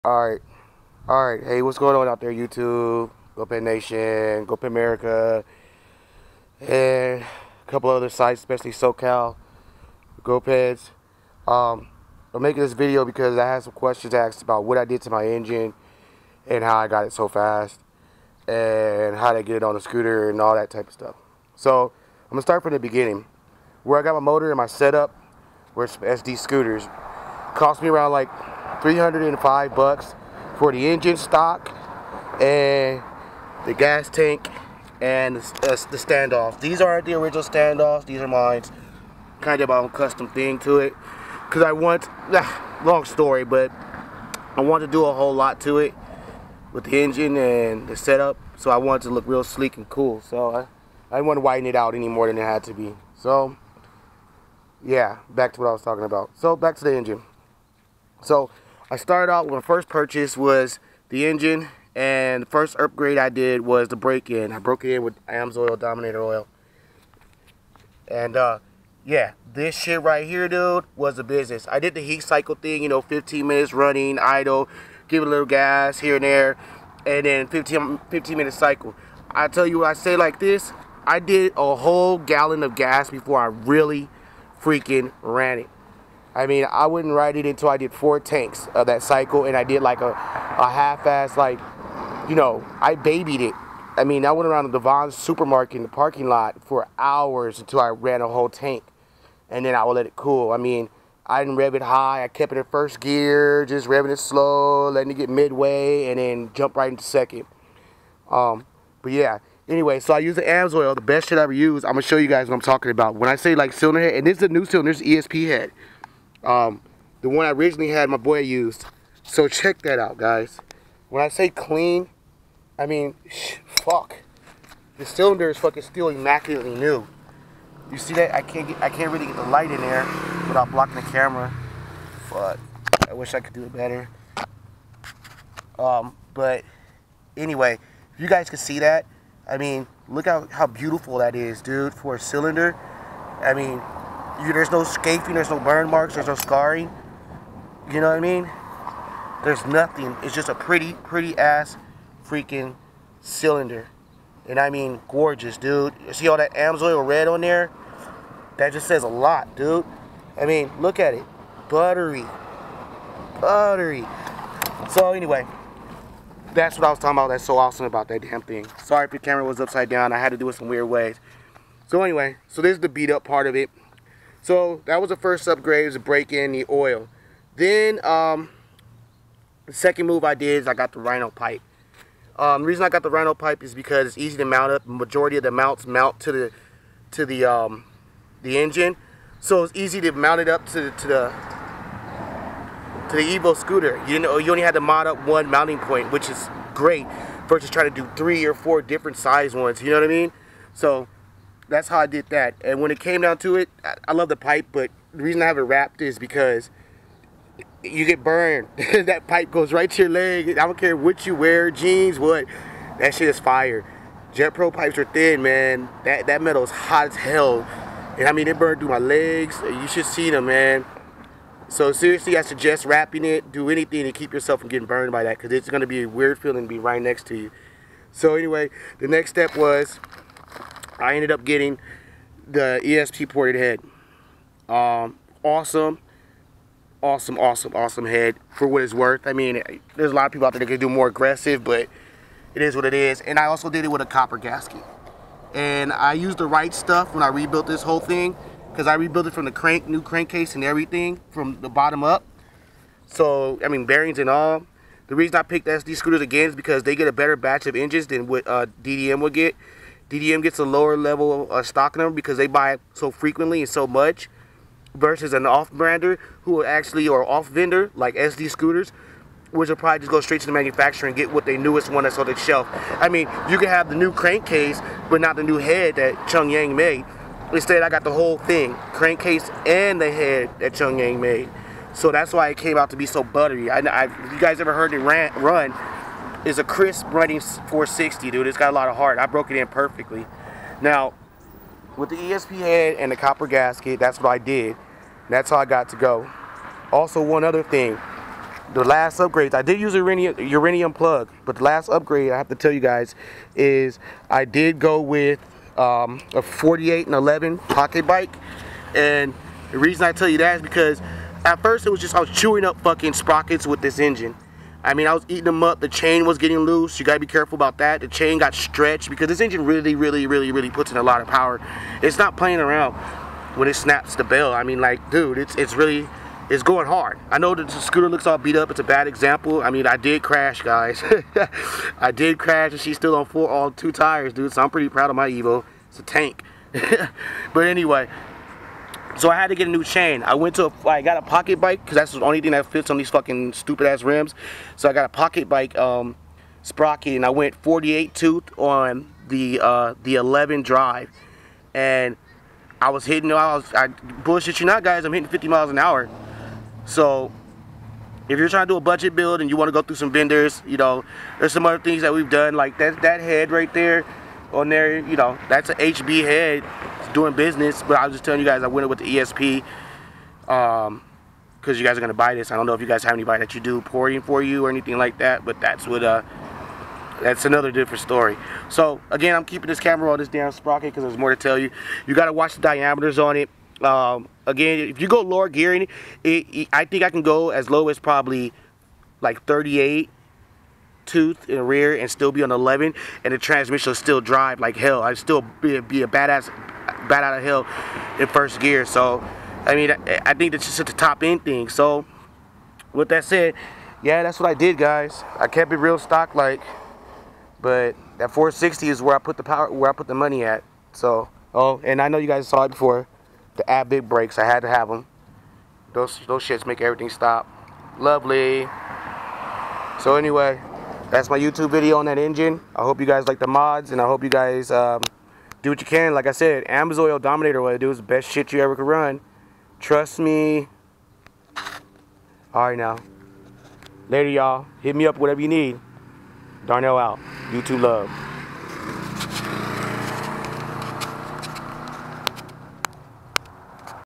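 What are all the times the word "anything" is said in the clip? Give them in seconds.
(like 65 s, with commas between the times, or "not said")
223 s, 374 s.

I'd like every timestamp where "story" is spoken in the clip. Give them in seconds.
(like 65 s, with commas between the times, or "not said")
43 s, 378 s.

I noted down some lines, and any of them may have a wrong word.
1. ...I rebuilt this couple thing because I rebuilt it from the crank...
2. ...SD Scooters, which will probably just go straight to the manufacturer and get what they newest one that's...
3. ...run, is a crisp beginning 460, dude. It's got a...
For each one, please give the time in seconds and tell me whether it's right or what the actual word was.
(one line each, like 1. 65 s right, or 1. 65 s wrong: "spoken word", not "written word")
1. 247 s wrong: "whole", not "couple"
2. 268 s right
3. 285 s wrong: "running", not "beginning".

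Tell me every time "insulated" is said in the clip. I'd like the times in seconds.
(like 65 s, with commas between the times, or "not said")
not said.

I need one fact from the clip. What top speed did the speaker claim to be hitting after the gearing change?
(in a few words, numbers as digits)
50 mph.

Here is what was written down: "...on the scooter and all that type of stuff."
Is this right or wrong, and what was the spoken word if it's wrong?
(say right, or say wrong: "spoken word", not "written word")
right.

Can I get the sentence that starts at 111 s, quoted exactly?
I'm gonna show you guys what I'm talking about.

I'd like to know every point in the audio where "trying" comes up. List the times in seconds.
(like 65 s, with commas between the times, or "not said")
197 s, 358 s.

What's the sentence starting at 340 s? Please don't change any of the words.
I went to, a, I got a pocket bike because that's the only thing that fits on these fucking stupid ass rims.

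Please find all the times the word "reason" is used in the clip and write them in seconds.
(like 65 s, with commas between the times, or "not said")
182 s, 205 s, 255 s, 309 s.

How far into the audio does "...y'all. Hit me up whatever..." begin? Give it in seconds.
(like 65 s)
434 s.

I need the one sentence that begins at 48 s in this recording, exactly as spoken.
So I wanted to look real sleek and cool.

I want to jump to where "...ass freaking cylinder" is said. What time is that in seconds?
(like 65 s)
151 s.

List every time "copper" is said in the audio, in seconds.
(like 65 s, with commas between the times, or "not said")
244 s, 293 s.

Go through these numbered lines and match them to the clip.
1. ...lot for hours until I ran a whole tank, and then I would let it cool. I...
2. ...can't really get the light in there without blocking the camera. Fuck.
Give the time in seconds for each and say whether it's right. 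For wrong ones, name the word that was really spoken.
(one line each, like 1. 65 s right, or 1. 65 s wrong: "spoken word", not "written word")
1. 96 s right
2. 128 s right.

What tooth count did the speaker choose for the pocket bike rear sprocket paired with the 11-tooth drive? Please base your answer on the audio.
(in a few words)
48.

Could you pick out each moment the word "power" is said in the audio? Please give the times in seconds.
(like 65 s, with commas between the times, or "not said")
321 s, 409 s.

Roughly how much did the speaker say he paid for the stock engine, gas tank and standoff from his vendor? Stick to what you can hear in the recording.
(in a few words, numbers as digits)
$305.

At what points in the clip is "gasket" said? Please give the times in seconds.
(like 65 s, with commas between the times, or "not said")
244 s, 293 s.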